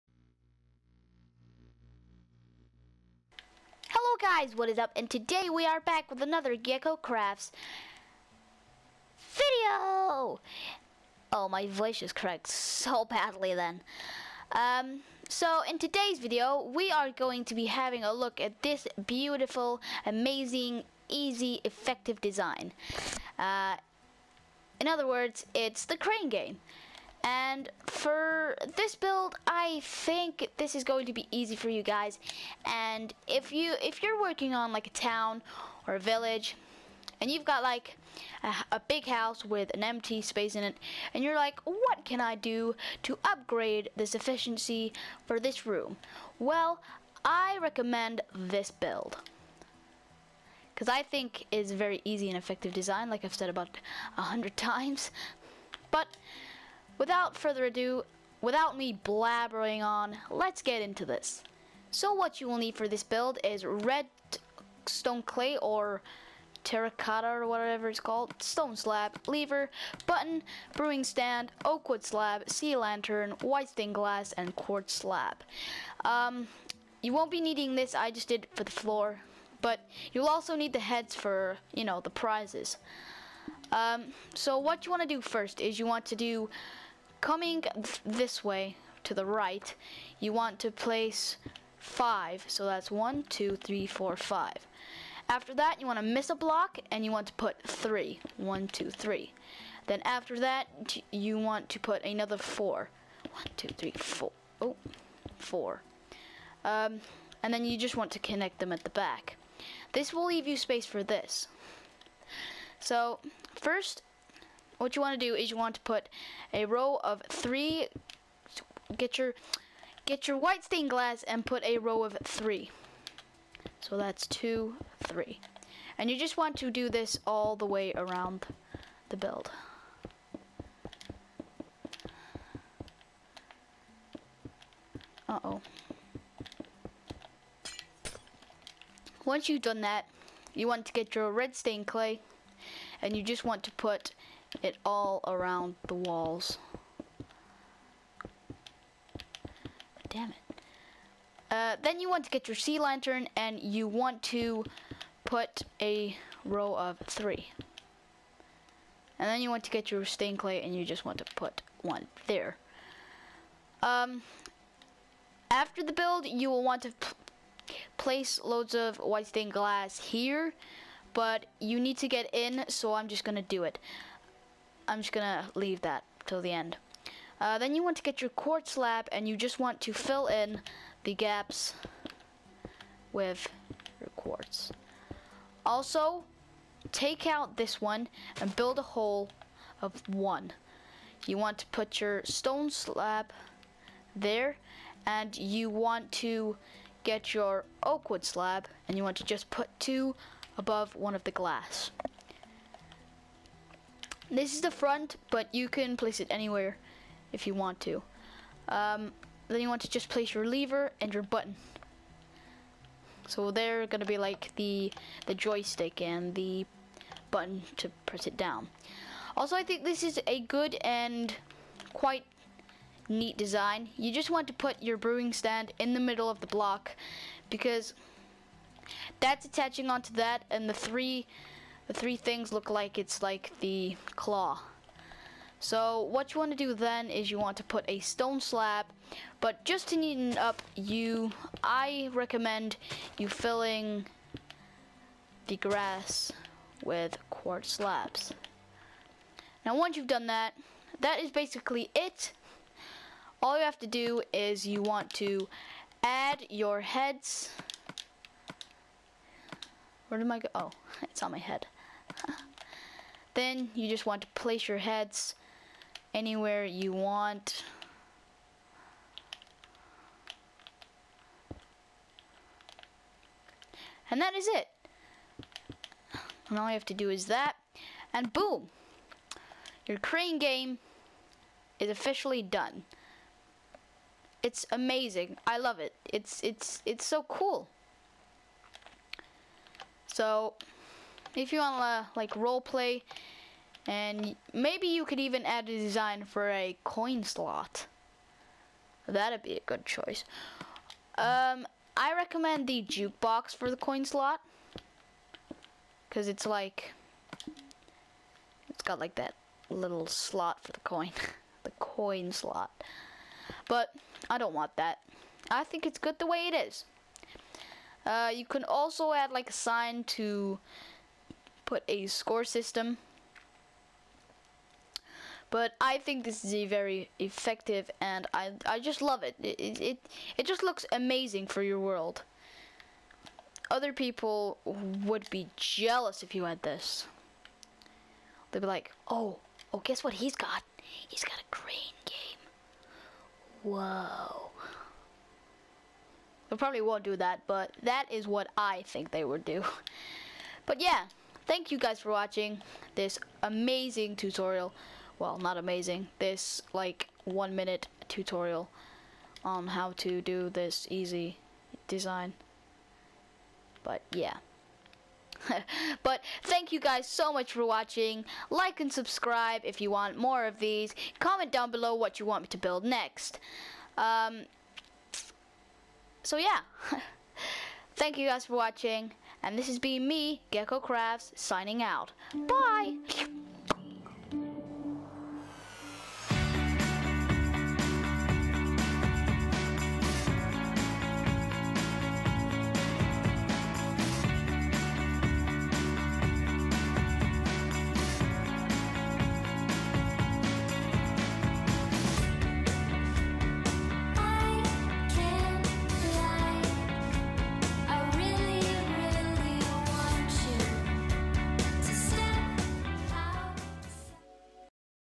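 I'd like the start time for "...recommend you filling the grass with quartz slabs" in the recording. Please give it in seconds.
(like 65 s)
242 s.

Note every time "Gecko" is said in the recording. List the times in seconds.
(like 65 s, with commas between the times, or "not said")
6 s, 380 s.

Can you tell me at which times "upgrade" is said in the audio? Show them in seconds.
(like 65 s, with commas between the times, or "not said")
43 s.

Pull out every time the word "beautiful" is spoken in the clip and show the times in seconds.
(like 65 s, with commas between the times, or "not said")
19 s.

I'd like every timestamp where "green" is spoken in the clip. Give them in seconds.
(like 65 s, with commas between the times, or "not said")
341 s.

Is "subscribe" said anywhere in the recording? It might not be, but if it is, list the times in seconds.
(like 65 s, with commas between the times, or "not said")
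368 s.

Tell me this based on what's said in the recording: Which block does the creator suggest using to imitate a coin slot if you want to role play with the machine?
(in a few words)
Jukebox.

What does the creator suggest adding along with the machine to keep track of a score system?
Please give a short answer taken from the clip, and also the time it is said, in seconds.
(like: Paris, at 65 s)
A sign, at 319 s.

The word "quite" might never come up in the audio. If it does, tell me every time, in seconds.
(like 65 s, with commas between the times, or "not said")
221 s.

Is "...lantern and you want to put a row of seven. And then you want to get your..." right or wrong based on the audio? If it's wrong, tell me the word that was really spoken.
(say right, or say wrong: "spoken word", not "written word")
wrong: "three", not "seven".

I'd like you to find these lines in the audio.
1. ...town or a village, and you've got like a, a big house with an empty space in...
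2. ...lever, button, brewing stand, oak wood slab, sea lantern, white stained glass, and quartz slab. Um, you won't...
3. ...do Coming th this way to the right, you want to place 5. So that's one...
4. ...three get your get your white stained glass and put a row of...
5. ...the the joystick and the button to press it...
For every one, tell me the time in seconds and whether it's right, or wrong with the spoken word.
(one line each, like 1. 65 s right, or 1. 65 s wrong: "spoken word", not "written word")
1. 34 s right
2. 69 s right
3. 86 s right
4. 117 s right
5. 214 s right.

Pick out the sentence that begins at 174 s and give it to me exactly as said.
I'm just gonna leave that till the end.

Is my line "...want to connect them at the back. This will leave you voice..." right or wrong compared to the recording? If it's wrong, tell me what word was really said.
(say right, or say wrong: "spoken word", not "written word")
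wrong: "space", not "voice".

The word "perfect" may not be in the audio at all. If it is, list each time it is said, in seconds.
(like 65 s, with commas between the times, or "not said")
not said.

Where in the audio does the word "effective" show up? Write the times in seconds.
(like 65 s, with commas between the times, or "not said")
21 s, 52 s, 327 s.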